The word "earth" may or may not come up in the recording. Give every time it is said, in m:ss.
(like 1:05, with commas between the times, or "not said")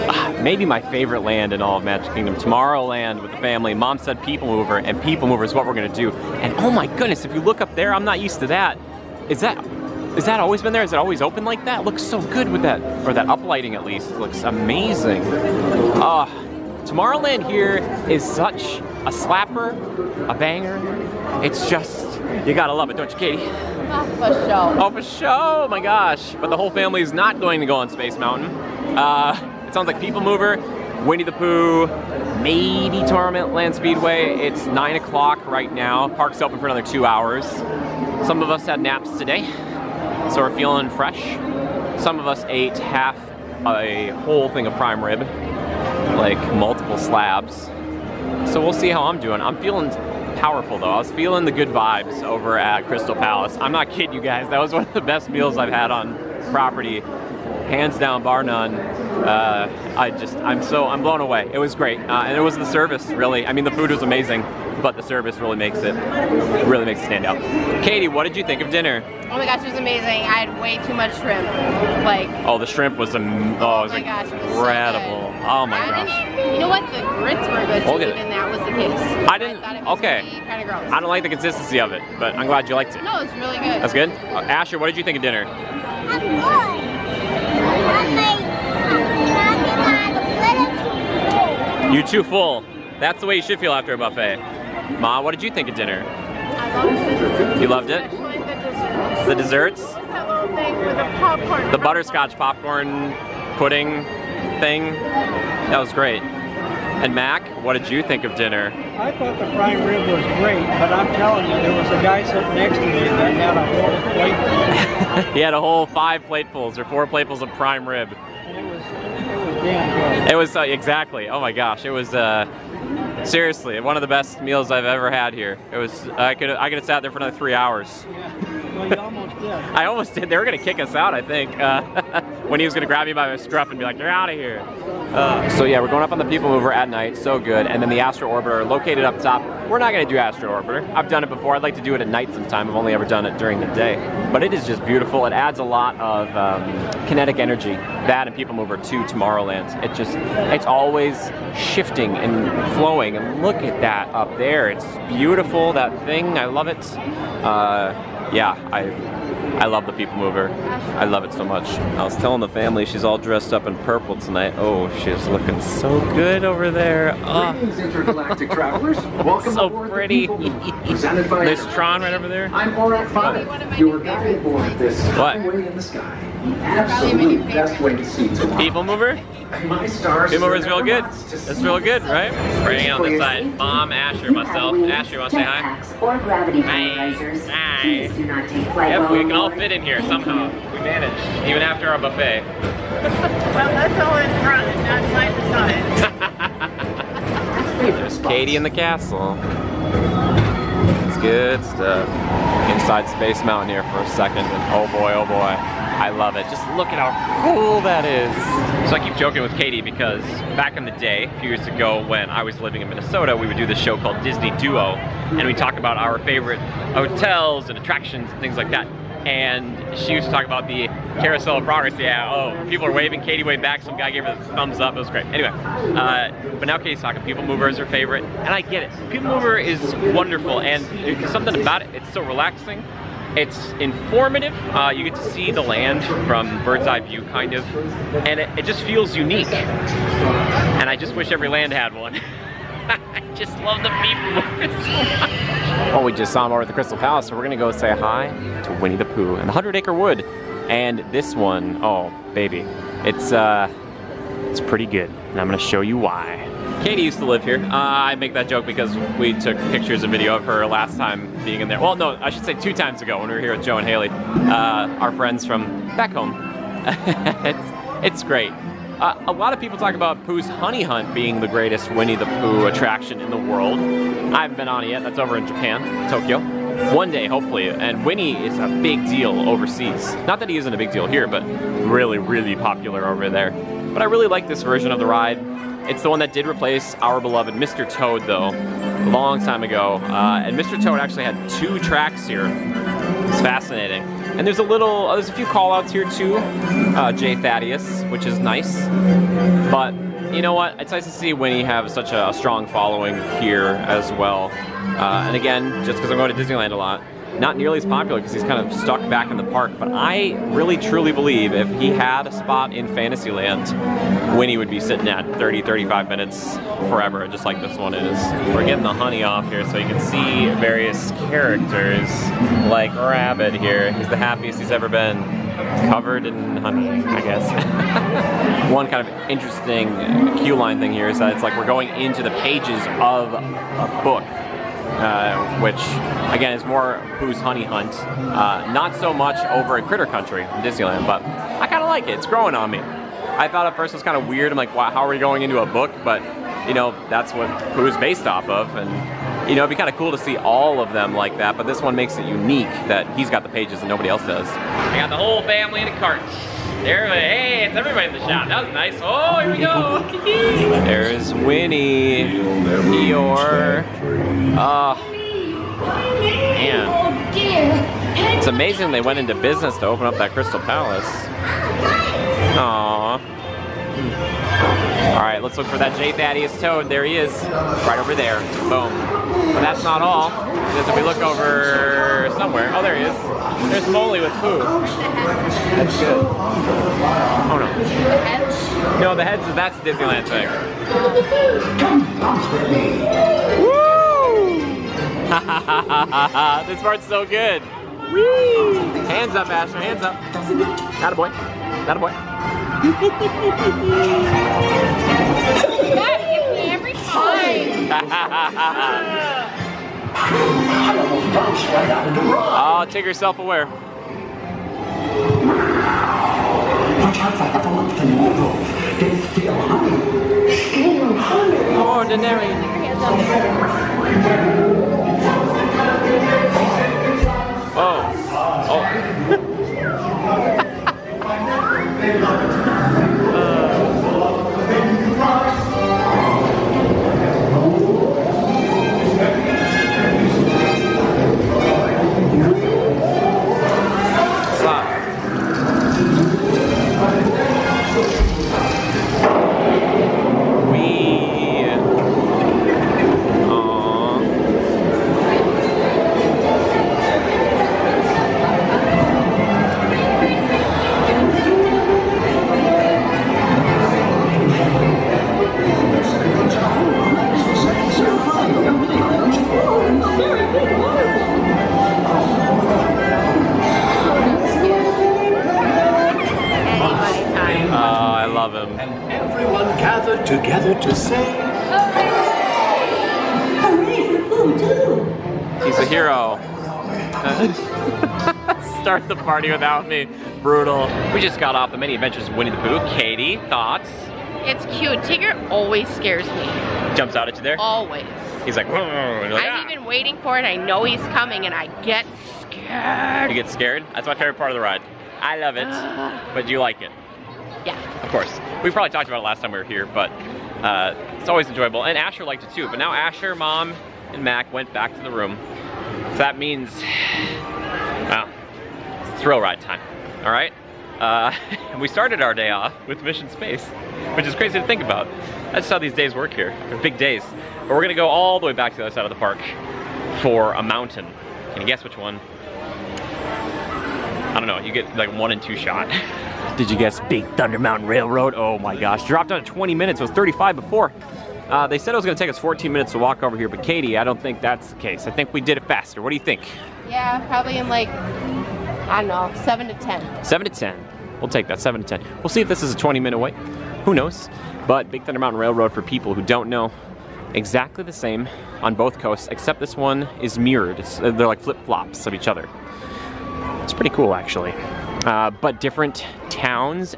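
not said.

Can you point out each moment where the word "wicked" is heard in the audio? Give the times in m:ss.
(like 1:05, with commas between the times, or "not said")
not said.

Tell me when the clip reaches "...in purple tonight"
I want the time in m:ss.
2:43.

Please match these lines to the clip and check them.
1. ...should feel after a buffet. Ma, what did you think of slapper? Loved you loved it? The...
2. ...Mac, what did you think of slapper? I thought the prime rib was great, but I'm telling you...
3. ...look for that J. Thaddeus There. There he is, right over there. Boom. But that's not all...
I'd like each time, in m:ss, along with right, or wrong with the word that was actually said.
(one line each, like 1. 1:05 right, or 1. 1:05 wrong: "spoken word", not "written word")
1. 1:33 wrong: "dinner", not "slapper"
2. 1:47 wrong: "dinner", not "slapper"
3. 6:15 wrong: "Toad", not "There".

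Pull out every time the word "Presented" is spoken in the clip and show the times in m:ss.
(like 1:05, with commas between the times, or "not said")
2:50.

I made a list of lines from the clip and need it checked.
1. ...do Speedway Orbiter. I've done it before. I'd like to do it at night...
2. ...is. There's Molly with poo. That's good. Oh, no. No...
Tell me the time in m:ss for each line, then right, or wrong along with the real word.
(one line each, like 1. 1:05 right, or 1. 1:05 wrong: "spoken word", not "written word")
1. 2:20 wrong: "Astro", not "Speedway"
2. 6:23 right.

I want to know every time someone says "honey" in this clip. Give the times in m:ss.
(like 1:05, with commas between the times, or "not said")
4:30, 5:18, 5:26, 5:37.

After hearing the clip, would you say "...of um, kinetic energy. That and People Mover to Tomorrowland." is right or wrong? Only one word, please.
right.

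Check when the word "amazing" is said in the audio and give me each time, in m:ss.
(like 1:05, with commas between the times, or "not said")
0:14, 1:04, 1:09, 6:08.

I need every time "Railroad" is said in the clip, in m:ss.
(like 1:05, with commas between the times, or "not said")
8:57, 9:15.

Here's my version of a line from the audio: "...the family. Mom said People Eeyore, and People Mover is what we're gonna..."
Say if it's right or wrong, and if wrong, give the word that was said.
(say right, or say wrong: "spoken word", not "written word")
wrong: "Mover", not "Eeyore".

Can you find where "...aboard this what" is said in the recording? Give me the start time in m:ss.
2:54.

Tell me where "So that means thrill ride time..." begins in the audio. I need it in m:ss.
8:36.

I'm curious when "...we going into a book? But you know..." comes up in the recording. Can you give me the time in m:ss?
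5:45.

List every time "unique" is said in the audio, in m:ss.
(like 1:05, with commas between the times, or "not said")
3:59, 5:52.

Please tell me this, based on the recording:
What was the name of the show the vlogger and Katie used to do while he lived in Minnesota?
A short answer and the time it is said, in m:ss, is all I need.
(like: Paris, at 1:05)
Disney Duo, at 3:34.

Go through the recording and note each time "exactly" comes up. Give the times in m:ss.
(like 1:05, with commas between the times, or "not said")
2:00, 9:17.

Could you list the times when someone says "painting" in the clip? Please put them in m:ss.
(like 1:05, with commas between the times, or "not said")
not said.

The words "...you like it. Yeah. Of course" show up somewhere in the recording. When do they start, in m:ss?
8:26.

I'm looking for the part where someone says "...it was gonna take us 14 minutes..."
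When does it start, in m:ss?
9:01.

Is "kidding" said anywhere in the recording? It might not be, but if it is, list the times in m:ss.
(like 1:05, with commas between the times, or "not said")
0:53.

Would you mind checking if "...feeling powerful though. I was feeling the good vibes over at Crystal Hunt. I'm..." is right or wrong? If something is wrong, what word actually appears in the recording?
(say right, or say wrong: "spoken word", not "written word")
wrong: "Palace", not "Hunt".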